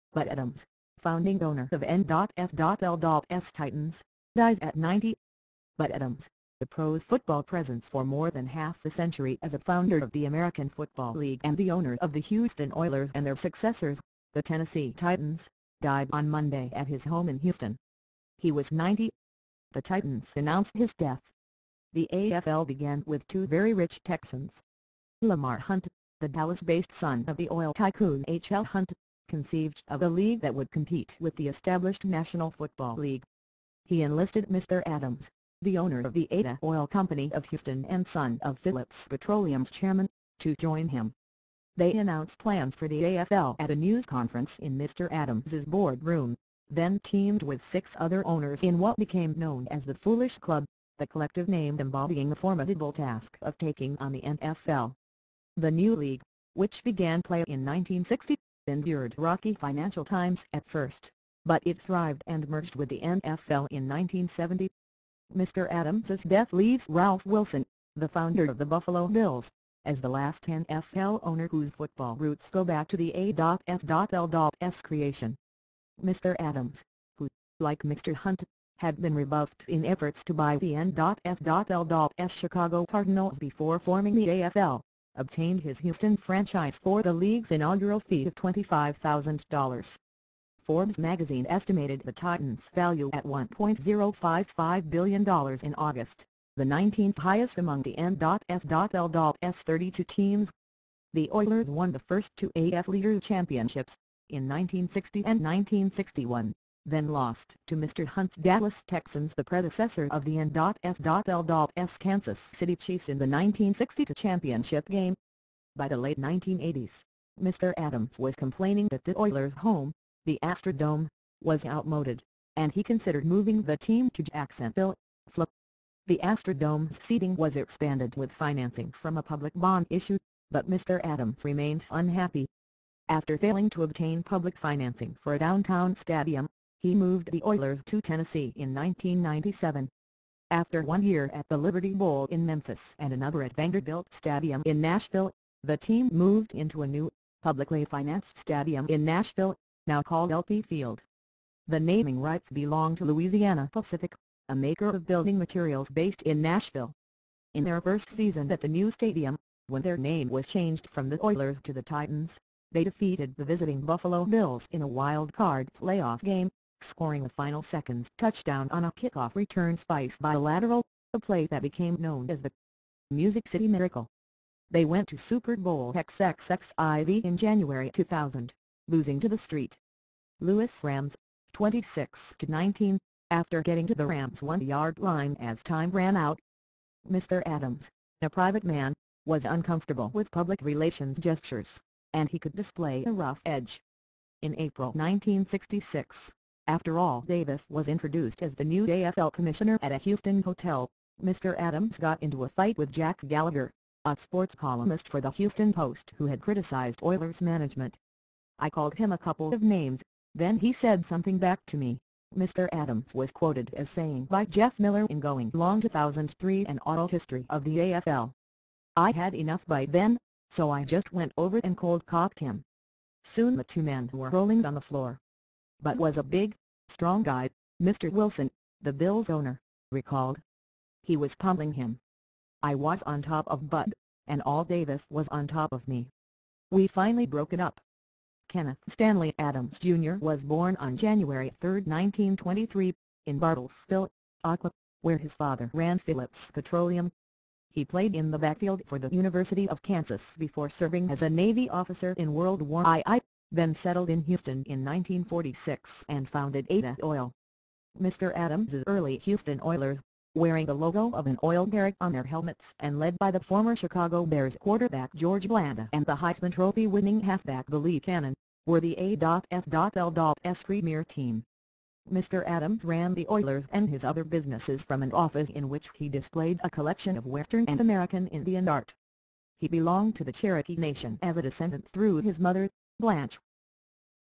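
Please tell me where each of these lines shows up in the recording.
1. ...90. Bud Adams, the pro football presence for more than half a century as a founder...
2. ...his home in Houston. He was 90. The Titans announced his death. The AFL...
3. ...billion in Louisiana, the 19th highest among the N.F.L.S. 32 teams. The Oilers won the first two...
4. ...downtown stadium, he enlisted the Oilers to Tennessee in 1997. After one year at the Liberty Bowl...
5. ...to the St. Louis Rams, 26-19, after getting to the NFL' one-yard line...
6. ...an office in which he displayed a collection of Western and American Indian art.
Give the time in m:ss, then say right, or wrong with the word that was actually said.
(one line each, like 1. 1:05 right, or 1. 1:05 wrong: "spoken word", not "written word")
1. 0:04 right
2. 0:16 right
3. 1:34 wrong: "August", not "Louisiana"
4. 2:15 wrong: "moved", not "enlisted"
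5. 2:59 wrong: "Rams", not "NFL"
6. 4:35 right.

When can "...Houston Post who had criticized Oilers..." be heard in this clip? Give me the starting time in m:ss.
3:25.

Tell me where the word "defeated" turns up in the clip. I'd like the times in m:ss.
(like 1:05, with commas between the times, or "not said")
2:42.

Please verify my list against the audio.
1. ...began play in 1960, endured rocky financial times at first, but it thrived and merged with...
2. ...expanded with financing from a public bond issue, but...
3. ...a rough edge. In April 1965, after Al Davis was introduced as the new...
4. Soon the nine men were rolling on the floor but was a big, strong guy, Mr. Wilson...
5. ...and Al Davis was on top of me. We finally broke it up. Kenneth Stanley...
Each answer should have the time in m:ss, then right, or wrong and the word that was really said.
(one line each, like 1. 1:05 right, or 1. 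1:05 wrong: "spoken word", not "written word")
1. 0:56 right
2. 2:07 right
3. 3:13 wrong: "1966", not "1965"
4. 3:43 wrong: "two", not "nine"
5. 3:54 right.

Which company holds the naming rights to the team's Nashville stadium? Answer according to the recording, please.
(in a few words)
Louisiana Pacific.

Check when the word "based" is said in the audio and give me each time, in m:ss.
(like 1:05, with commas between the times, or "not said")
0:26, 2:35.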